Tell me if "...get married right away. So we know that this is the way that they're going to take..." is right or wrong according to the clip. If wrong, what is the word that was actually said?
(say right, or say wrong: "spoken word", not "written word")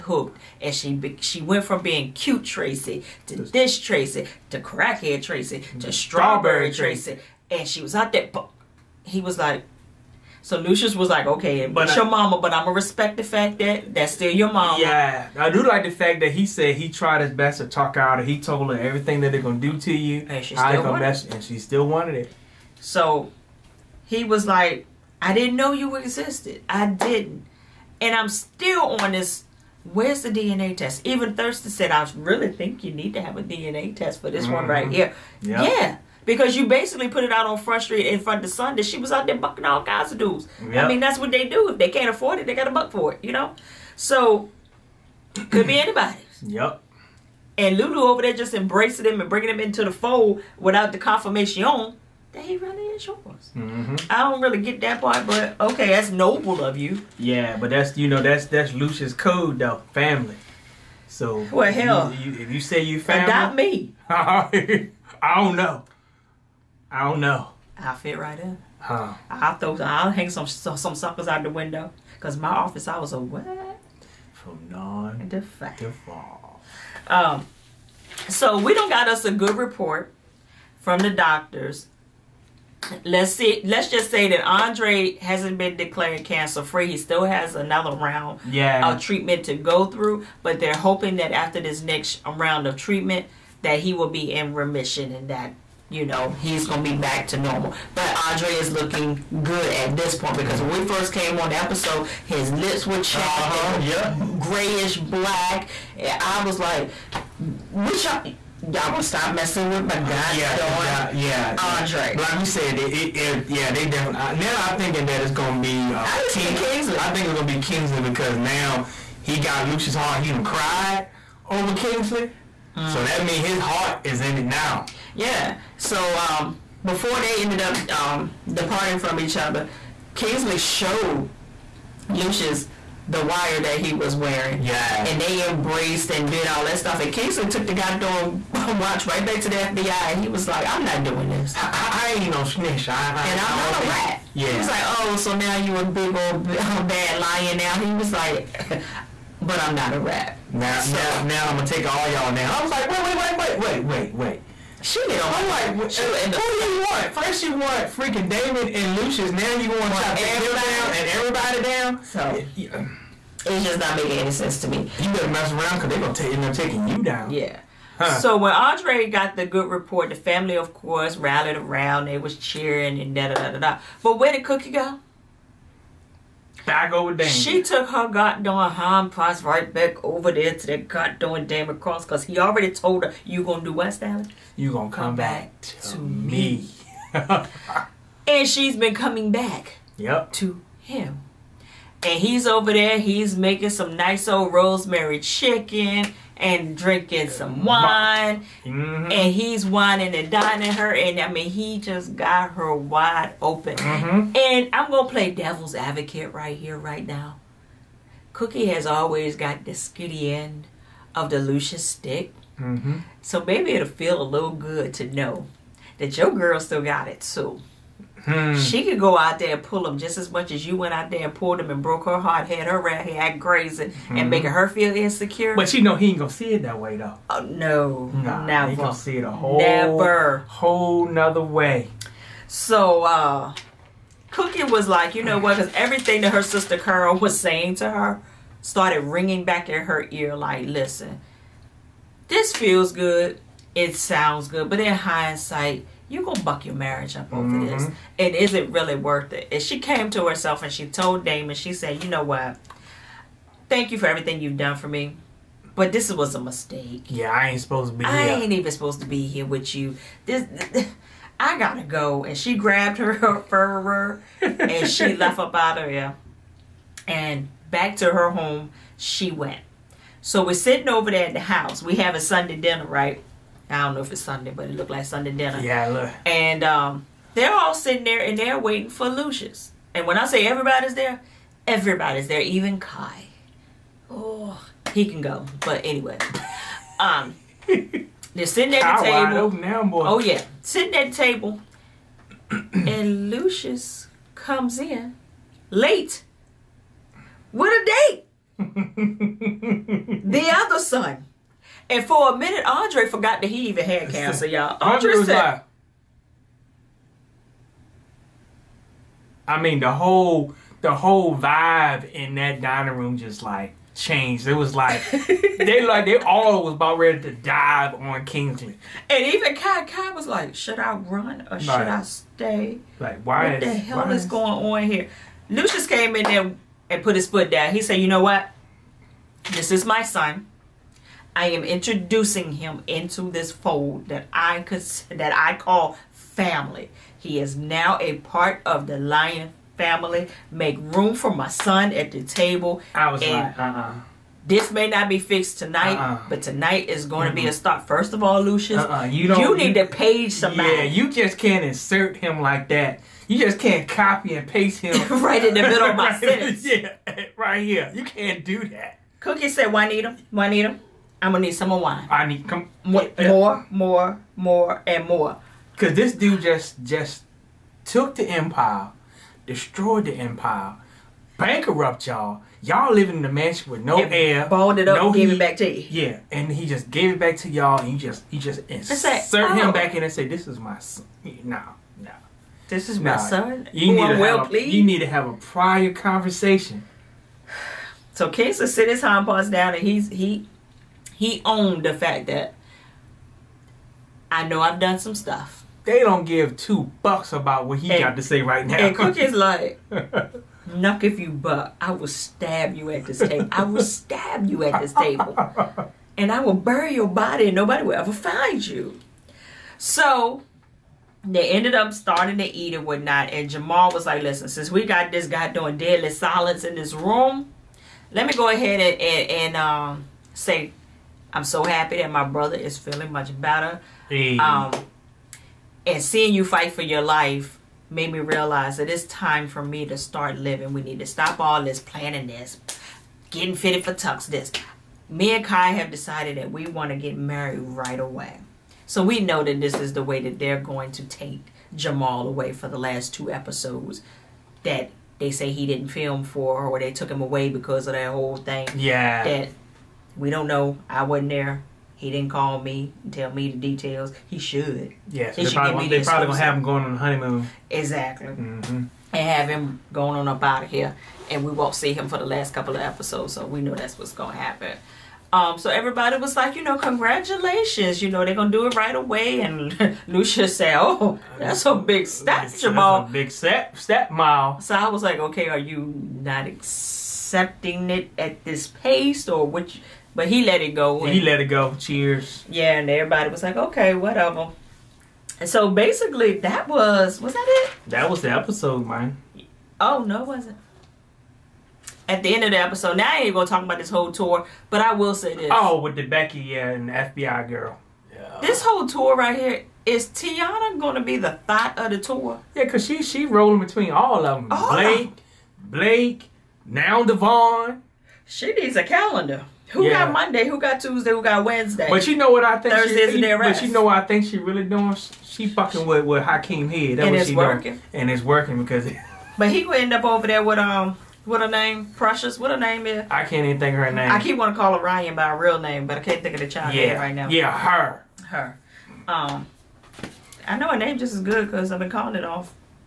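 right.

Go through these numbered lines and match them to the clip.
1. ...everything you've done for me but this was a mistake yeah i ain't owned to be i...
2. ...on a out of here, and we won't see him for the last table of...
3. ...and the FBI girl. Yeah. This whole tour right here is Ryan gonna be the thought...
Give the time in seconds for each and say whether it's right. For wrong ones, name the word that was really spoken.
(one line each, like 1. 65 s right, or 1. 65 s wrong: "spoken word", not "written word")
1. 254 s wrong: "supposed", not "owned"
2. 460 s wrong: "couple", not "table"
3. 496 s wrong: "Tiana", not "Ryan".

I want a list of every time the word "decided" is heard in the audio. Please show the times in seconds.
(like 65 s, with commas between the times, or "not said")
435 s.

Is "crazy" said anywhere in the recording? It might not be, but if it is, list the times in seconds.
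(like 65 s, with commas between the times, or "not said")
223 s.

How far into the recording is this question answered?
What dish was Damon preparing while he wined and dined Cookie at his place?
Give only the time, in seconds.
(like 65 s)
194 s.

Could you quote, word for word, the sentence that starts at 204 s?
and i'm gonna play devil's advocate right here right now cookie has always got the skitty end of the lucious stick mm-hmm.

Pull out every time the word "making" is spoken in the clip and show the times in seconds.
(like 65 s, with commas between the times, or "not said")
163 s, 193 s, 224 s.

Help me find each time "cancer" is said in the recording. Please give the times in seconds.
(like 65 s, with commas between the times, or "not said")
86 s, 304 s.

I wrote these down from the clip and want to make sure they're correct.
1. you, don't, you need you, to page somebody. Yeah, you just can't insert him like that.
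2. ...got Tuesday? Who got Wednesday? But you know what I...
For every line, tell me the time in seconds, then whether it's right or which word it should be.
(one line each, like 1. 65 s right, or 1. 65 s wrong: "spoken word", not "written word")
1. 349 s right
2. 510 s right.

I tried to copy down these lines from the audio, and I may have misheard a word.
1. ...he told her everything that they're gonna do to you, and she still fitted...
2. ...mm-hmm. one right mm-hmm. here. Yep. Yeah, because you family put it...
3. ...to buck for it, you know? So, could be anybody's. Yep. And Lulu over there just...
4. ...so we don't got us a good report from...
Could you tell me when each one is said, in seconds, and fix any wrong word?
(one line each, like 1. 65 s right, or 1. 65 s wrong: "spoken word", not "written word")
1. 18 s wrong: "wanted", not "fitted"
2. 34 s wrong: "basically", not "family"
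3. 42 s right
4. 78 s right.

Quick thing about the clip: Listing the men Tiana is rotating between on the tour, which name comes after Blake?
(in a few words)
Devon.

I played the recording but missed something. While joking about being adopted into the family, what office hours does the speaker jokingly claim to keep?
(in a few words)
9 to 5.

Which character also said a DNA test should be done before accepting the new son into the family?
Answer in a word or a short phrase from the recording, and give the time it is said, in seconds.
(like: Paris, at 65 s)
Thurston, at 31 s.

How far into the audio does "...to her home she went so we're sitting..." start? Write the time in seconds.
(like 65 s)
267 s.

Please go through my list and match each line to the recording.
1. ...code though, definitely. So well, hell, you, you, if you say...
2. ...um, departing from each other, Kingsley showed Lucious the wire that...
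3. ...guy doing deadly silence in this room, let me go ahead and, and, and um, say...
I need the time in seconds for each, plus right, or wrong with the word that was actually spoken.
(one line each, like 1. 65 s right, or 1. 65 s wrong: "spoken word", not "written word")
1. 59 s wrong: "family", not "definitely"
2. 127 s right
3. 415 s right.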